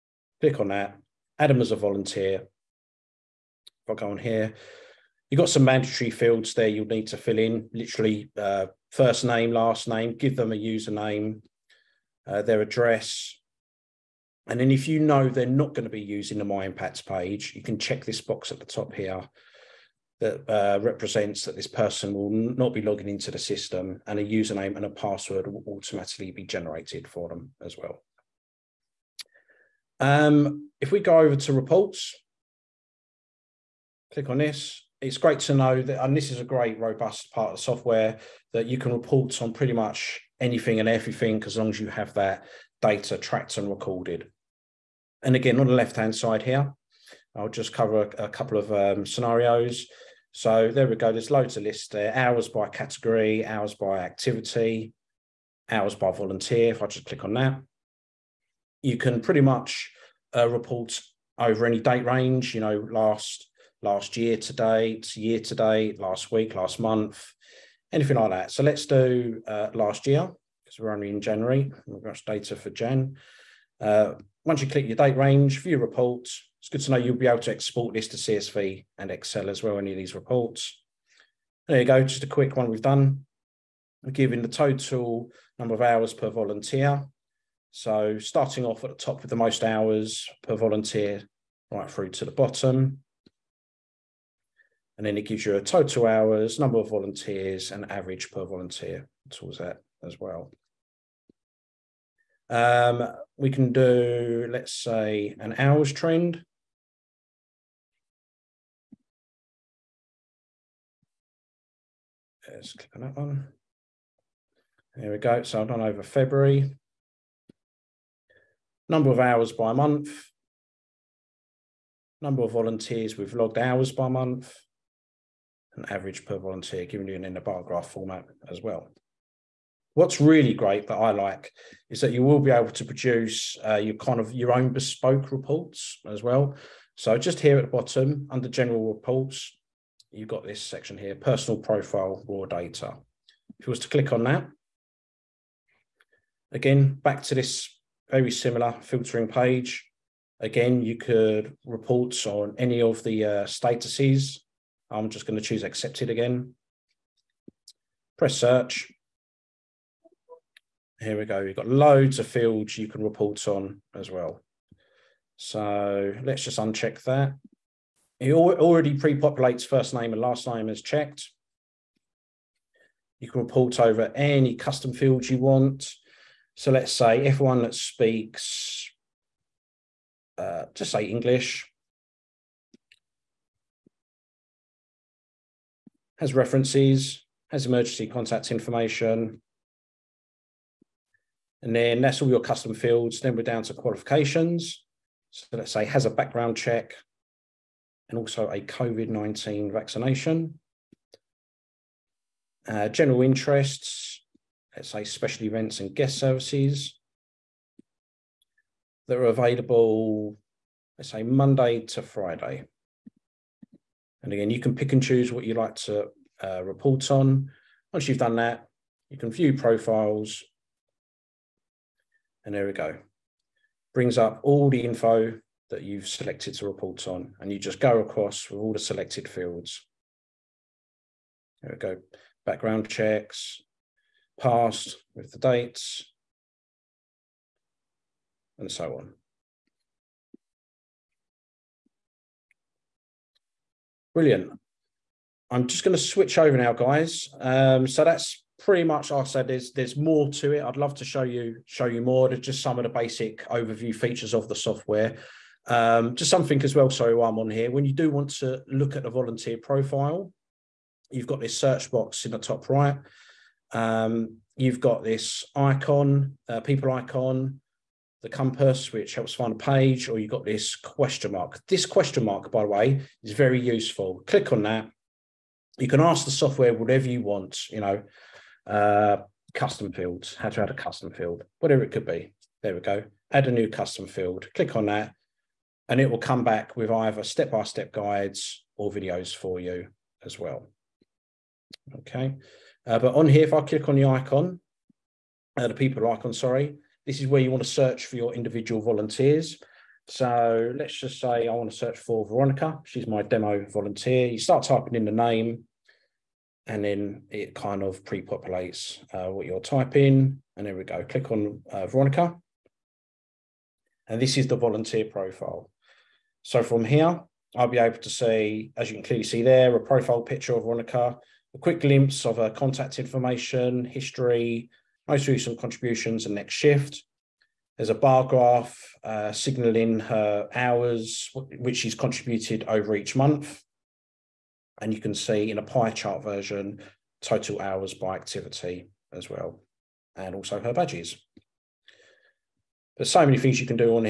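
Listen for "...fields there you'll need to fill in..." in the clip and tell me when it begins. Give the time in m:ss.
0:06.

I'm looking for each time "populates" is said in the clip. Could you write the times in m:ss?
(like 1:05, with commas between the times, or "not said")
2:48, 5:08.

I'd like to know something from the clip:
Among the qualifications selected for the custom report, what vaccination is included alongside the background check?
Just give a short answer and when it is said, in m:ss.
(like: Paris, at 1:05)
COVID-19, at 3:18.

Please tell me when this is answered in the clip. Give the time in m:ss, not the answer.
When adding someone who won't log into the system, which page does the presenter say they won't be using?
0:16.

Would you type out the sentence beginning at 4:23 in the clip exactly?
Um, you've got this icon, uh, people icon, the compass, which helps find a page, or you've got this question mark.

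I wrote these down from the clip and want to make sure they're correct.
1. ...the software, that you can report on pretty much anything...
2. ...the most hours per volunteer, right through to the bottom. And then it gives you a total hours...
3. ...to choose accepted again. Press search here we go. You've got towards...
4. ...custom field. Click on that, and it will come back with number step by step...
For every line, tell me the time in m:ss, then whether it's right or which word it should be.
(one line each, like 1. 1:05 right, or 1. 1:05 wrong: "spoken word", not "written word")
1. 0:37 right
2. 1:29 right
3. 2:35 wrong: "loads", not "towards"
4. 4:43 wrong: "either", not "number".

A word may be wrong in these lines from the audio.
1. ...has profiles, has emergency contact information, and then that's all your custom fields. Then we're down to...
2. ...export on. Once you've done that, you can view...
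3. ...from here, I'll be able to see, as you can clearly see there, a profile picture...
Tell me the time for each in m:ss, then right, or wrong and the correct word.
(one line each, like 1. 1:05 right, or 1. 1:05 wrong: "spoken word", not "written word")
1. 3:06 wrong: "references", not "profiles"
2. 3:36 wrong: "report", not "export"
3. 5:16 right.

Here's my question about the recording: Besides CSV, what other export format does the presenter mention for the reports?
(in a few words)
Excel.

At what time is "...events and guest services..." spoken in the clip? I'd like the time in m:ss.
3:25.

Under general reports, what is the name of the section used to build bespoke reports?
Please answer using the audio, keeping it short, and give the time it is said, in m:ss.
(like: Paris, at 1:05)
Personal profile, raw data, at 2:21.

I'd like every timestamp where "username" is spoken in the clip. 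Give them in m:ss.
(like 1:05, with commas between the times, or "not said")
0:10, 0:24.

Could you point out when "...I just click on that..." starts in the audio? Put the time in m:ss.
0:56.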